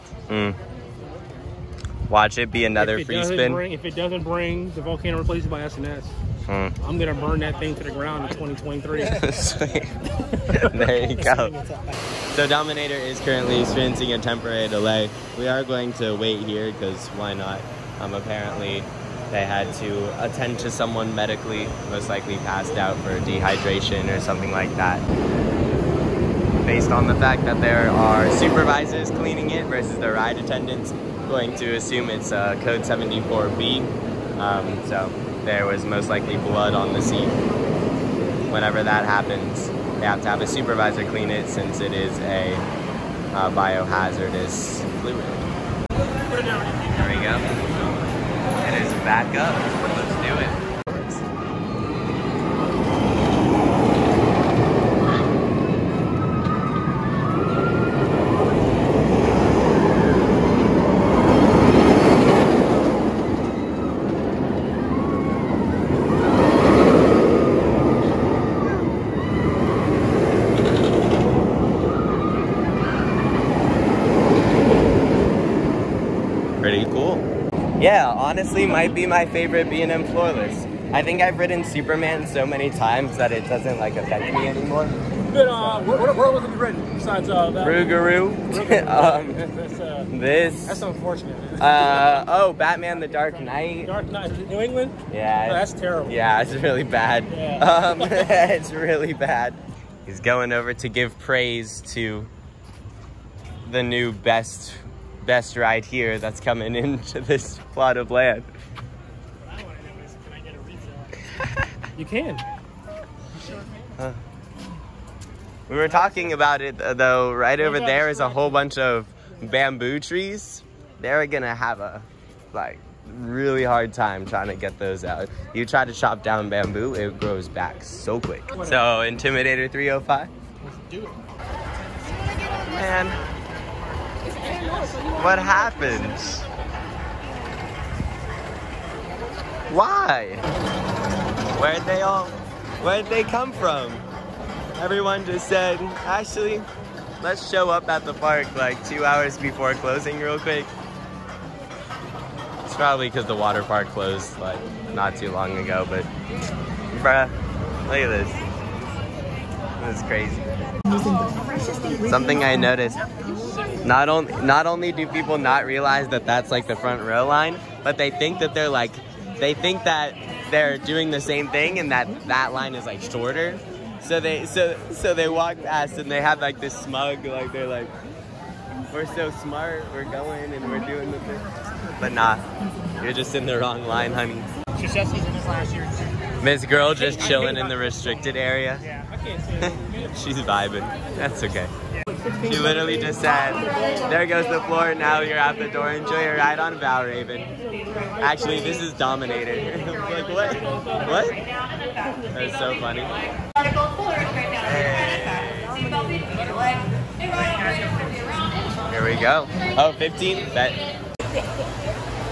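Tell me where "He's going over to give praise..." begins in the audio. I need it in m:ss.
1:40.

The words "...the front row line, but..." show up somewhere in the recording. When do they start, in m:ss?
2:46.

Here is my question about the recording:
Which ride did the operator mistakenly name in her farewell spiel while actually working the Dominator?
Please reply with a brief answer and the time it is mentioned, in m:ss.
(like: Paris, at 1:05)
Raven, at 3:17.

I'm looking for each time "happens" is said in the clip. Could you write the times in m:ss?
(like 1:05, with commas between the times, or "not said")
0:39, 2:15.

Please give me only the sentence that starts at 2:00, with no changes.
They're gonna have a like really hard time trying to get those out.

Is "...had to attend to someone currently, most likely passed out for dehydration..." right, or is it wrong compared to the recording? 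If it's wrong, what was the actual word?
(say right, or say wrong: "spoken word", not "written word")
wrong: "medically", not "currently".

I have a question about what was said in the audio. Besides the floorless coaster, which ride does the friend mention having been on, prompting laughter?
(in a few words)
Rougarou.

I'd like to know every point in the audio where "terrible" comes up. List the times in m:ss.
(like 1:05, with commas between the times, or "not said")
1:35.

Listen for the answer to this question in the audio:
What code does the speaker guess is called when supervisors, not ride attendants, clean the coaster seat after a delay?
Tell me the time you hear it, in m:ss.
0:32.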